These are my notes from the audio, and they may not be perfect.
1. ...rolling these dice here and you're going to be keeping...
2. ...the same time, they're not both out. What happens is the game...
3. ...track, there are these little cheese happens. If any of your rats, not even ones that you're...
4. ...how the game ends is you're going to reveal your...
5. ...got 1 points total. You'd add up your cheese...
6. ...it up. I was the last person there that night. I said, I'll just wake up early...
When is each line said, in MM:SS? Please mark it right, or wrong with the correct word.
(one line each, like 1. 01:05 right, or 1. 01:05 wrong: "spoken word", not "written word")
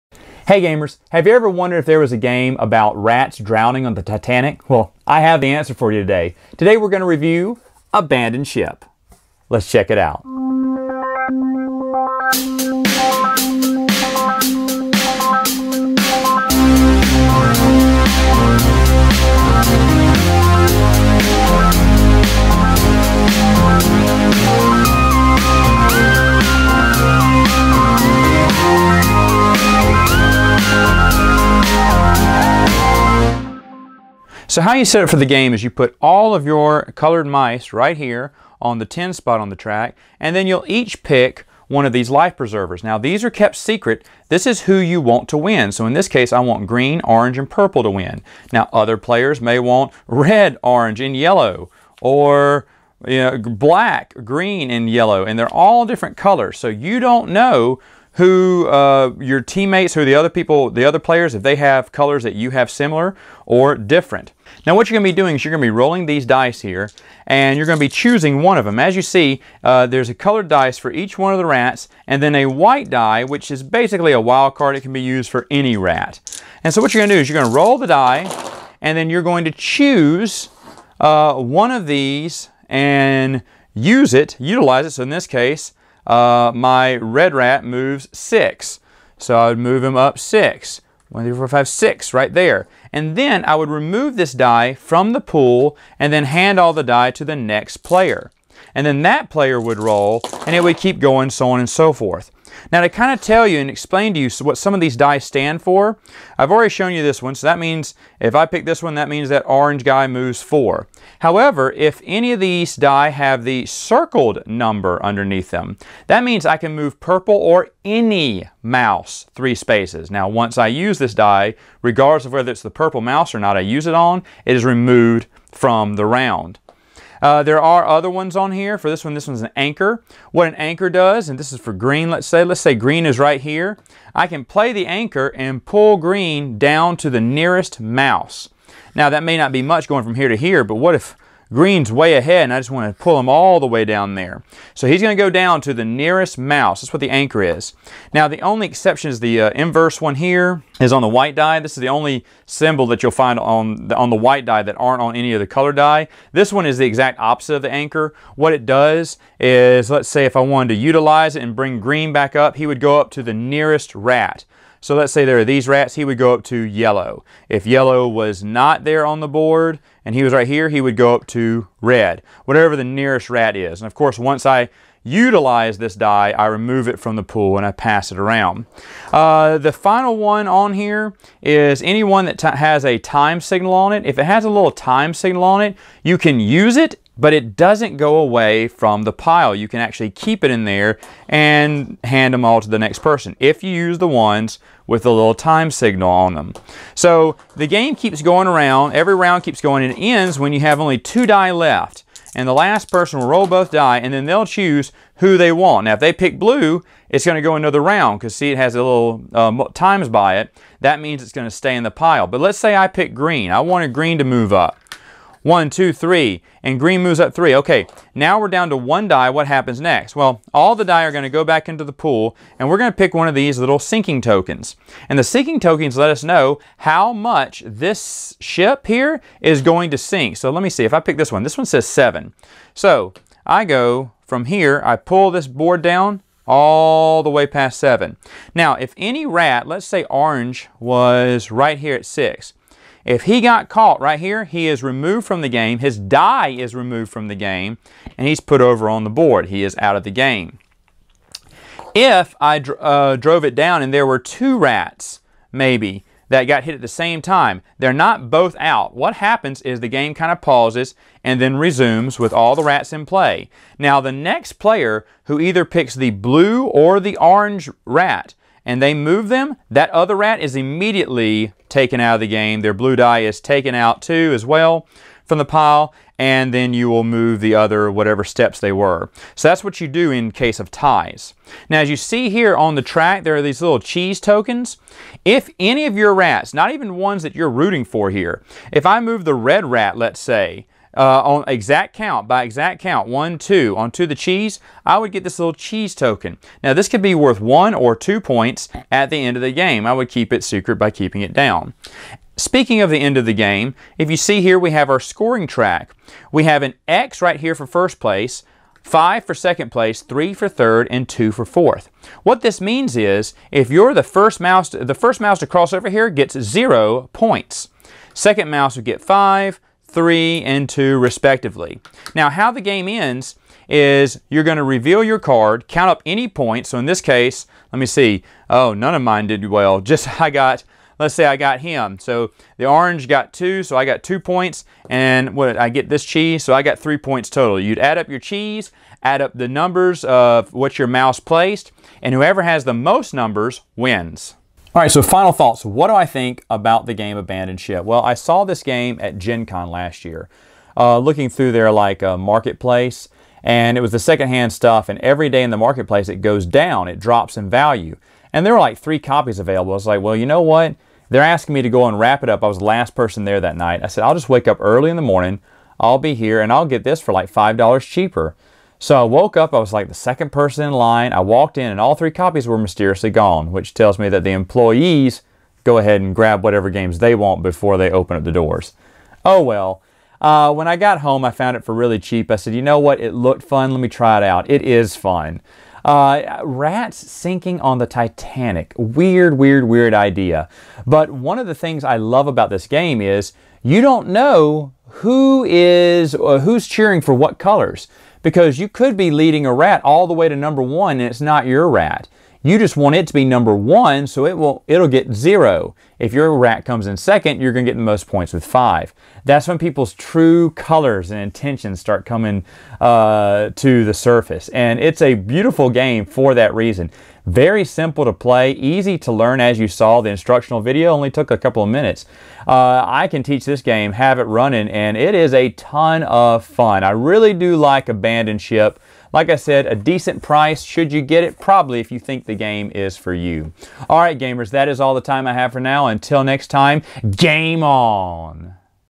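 1. 01:05 wrong: "choosing", not "keeping"
2. 04:16 right
3. 04:42 wrong: "tokens", not "happens"
4. 05:22 right
5. 05:36 wrong: "3", not "1"
6. 06:02 right.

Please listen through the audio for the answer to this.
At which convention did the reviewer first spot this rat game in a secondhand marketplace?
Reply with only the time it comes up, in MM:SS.
05:49.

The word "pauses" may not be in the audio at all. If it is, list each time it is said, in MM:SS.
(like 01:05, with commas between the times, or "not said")
04:20.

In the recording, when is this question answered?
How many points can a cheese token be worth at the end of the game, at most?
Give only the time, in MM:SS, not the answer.
04:57.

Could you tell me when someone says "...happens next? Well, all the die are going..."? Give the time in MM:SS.
03:39.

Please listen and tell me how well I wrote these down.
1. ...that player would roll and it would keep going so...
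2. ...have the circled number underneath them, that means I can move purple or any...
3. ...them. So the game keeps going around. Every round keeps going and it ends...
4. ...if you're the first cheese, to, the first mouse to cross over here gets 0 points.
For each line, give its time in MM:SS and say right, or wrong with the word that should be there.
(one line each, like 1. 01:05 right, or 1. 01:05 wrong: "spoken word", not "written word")
1. 01:39 right
2. 01:53 right
3. 03:16 right
4. 05:13 wrong: "mouse", not "cheese".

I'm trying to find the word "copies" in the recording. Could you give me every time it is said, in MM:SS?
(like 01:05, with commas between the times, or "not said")
05:58, 06:12.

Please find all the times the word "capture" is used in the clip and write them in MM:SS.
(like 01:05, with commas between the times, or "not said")
not said.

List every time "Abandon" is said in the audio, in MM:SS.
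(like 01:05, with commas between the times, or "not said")
00:07, 05:47, 07:07.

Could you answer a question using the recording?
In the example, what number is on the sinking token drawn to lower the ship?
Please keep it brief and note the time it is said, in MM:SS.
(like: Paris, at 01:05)
7, at 03:51.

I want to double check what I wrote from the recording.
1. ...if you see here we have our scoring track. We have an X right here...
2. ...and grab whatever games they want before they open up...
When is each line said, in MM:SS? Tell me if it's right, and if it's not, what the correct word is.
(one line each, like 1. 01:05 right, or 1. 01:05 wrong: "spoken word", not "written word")
1. 05:03 right
2. 06:16 right.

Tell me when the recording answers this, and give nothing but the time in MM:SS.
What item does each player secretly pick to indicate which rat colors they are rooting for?
00:42.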